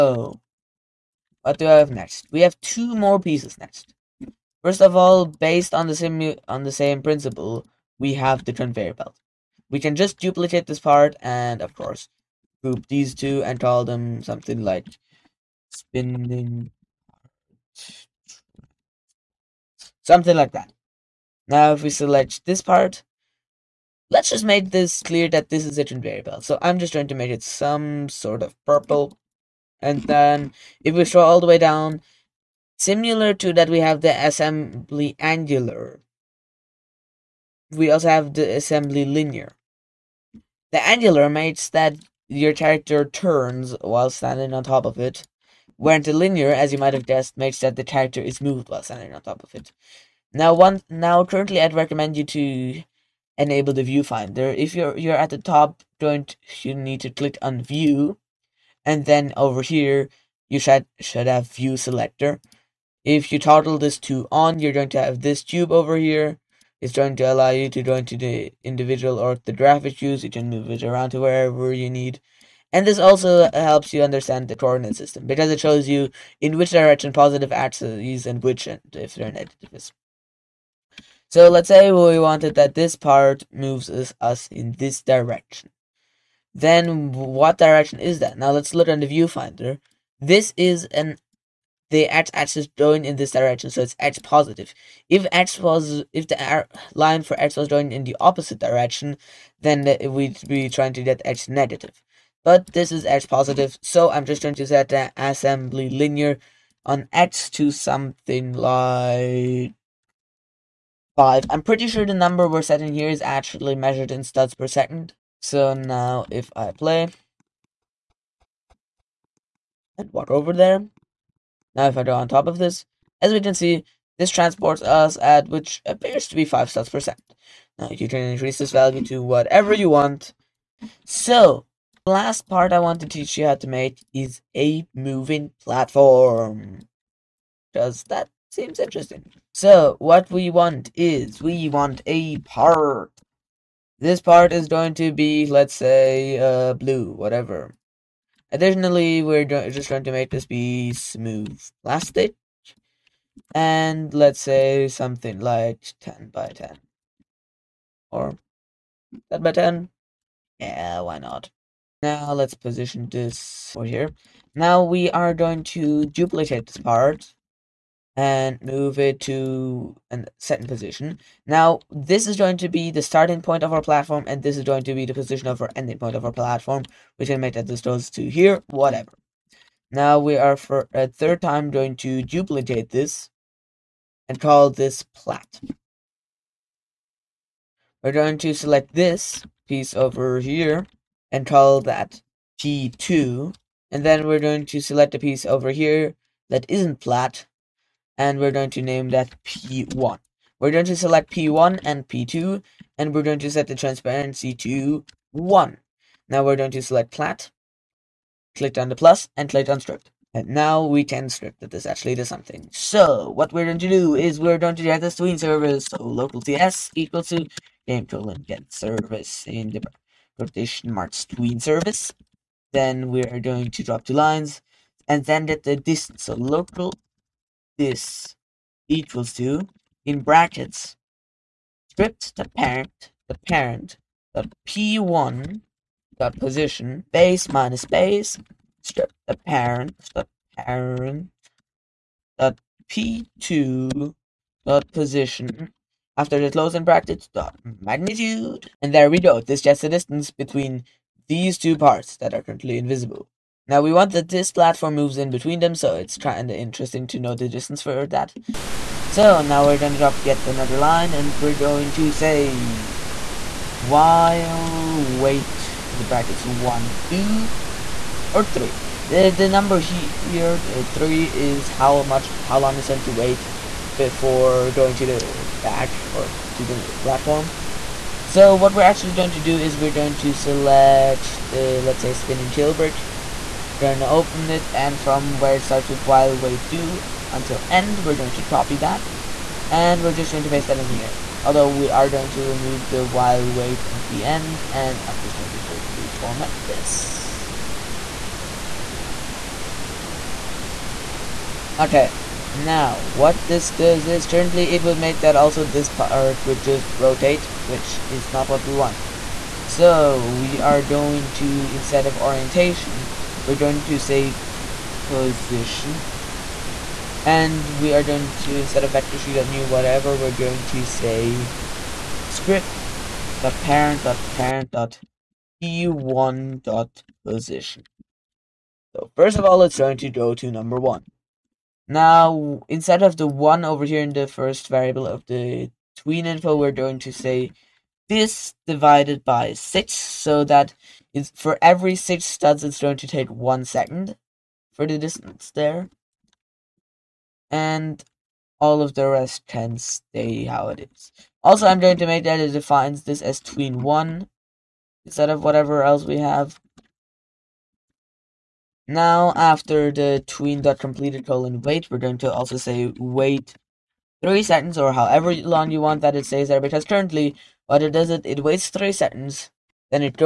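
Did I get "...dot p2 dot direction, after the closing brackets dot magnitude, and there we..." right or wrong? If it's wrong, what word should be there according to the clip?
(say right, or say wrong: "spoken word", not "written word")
wrong: "position", not "direction".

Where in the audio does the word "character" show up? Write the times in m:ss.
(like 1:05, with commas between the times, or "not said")
0:42, 0:47.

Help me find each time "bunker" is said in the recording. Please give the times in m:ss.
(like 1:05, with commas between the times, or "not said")
not said.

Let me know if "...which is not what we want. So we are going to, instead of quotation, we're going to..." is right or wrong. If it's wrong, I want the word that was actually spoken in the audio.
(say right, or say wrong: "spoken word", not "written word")
wrong: "orientation", not "quotation".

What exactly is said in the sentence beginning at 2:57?
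We can make that this goes to here, whatever.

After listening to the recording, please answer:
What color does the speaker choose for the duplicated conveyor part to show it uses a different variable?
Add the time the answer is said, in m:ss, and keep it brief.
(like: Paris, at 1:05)
Purple, at 0:28.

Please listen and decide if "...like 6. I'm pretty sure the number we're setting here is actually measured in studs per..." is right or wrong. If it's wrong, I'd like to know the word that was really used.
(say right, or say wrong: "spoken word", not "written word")
wrong: "5", not "6".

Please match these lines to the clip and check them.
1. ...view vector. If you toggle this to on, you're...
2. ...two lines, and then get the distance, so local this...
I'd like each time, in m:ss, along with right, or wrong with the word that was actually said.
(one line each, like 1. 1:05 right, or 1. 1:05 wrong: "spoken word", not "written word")
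1. 1:01 wrong: "selector", not "vector"
2. 3:44 right.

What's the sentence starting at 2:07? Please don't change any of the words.
Now you can increase this value to whatever you want.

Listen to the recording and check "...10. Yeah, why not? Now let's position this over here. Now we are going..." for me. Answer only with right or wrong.
right.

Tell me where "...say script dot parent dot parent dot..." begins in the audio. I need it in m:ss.
5:20.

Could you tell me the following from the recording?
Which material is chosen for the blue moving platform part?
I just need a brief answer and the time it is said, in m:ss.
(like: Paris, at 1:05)
Smooth plastic, at 2:30.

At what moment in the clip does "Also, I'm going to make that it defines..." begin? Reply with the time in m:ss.
5:51.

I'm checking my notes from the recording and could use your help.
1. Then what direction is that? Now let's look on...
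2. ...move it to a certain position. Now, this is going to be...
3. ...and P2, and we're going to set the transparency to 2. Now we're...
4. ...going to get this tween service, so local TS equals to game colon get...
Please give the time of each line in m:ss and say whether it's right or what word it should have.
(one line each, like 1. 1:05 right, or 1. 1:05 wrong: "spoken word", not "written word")
1. 1:26 right
2. 2:48 right
3. 3:21 wrong: "1", not "2"
4. 3:34 right.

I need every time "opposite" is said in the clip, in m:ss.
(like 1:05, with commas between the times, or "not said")
1:38.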